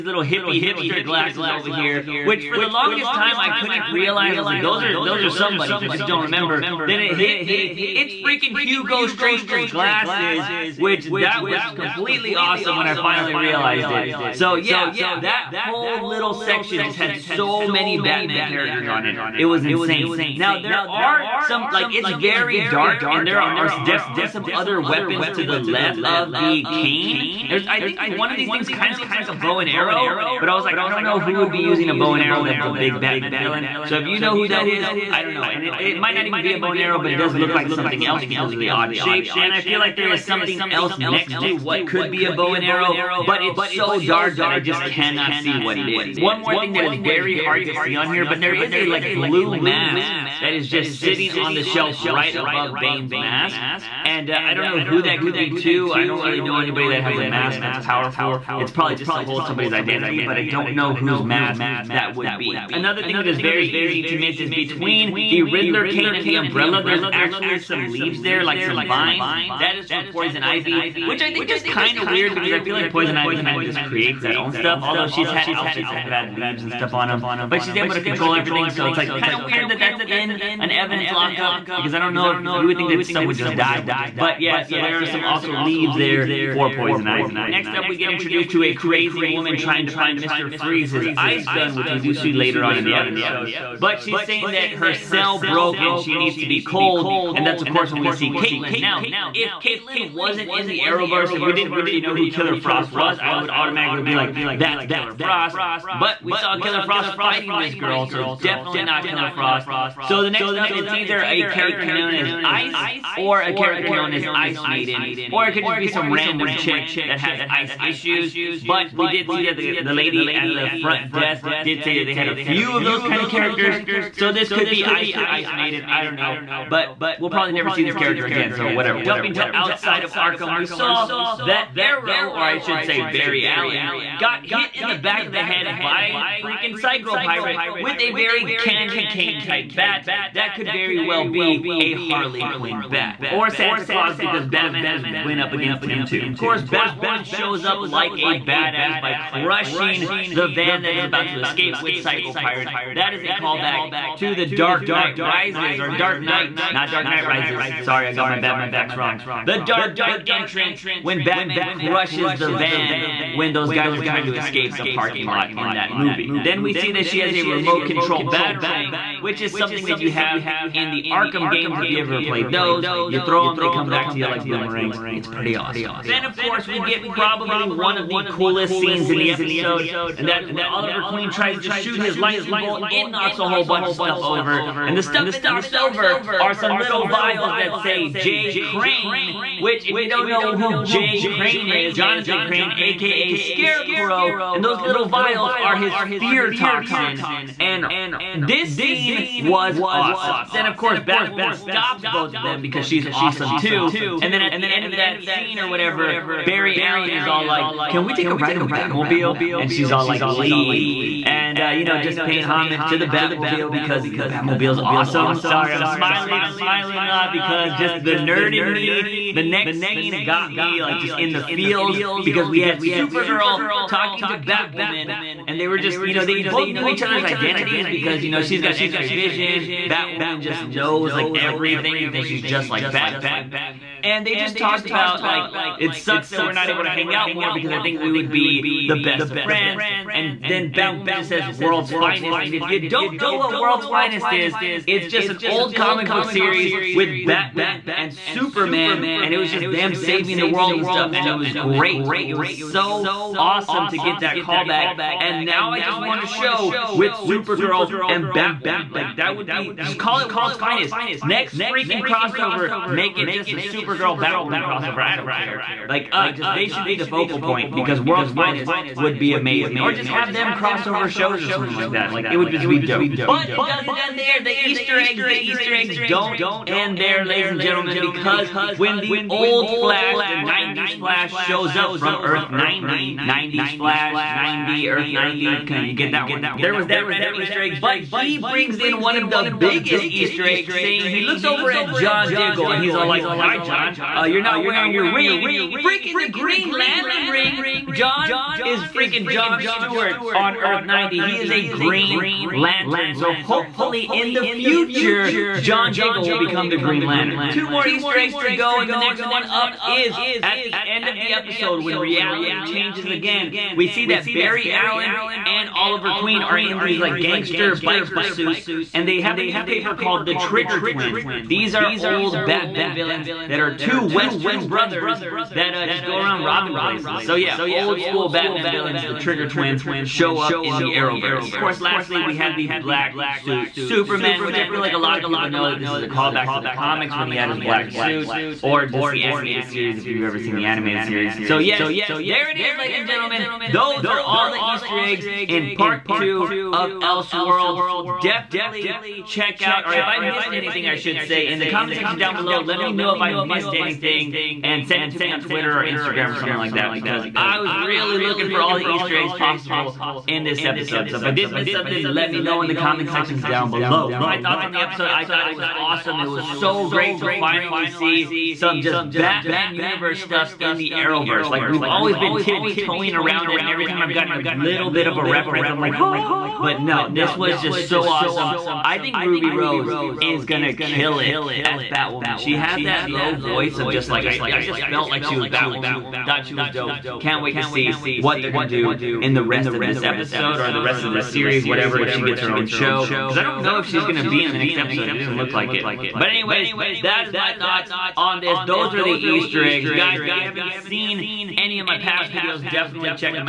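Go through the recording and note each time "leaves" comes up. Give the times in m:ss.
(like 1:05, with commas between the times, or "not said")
1:07, 1:16, 1:25, 3:30.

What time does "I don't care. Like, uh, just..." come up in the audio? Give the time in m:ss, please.
4:25.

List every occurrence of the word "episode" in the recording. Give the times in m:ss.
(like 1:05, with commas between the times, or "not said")
1:32, 2:59, 5:11, 6:00, 6:04, 6:30, 6:34.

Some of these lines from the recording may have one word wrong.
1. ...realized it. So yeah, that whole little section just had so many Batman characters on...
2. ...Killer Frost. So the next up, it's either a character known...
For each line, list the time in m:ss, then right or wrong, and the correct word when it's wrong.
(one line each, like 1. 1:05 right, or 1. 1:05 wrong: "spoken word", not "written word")
1. 0:13 right
2. 1:49 right.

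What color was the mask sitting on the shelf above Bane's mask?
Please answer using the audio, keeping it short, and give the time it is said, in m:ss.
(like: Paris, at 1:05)
Blue, at 0:49.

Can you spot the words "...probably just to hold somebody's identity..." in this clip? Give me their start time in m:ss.
0:58.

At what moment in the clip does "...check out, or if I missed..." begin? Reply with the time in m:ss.
5:49.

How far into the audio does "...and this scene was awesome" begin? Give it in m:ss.
3:17.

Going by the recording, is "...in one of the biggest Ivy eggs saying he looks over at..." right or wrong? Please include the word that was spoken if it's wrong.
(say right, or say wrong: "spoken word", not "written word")
wrong: "Easter", not "Ivy".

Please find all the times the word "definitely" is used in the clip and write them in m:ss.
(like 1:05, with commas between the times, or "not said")
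0:23, 1:48, 5:48, 6:42.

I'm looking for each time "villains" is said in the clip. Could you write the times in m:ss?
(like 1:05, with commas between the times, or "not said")
0:33, 5:22, 5:28.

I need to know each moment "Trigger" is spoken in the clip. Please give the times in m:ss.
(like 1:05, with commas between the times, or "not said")
5:20, 5:29.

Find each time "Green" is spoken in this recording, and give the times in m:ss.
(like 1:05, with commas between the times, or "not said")
4:56, 5:01, 5:06.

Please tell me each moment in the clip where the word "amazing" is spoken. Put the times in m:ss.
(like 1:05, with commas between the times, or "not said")
4:29.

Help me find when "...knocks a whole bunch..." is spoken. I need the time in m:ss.
3:03.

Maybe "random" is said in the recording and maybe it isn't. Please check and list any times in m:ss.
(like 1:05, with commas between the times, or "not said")
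1:56, 4:47.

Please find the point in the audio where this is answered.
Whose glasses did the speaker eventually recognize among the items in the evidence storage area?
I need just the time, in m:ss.
0:08.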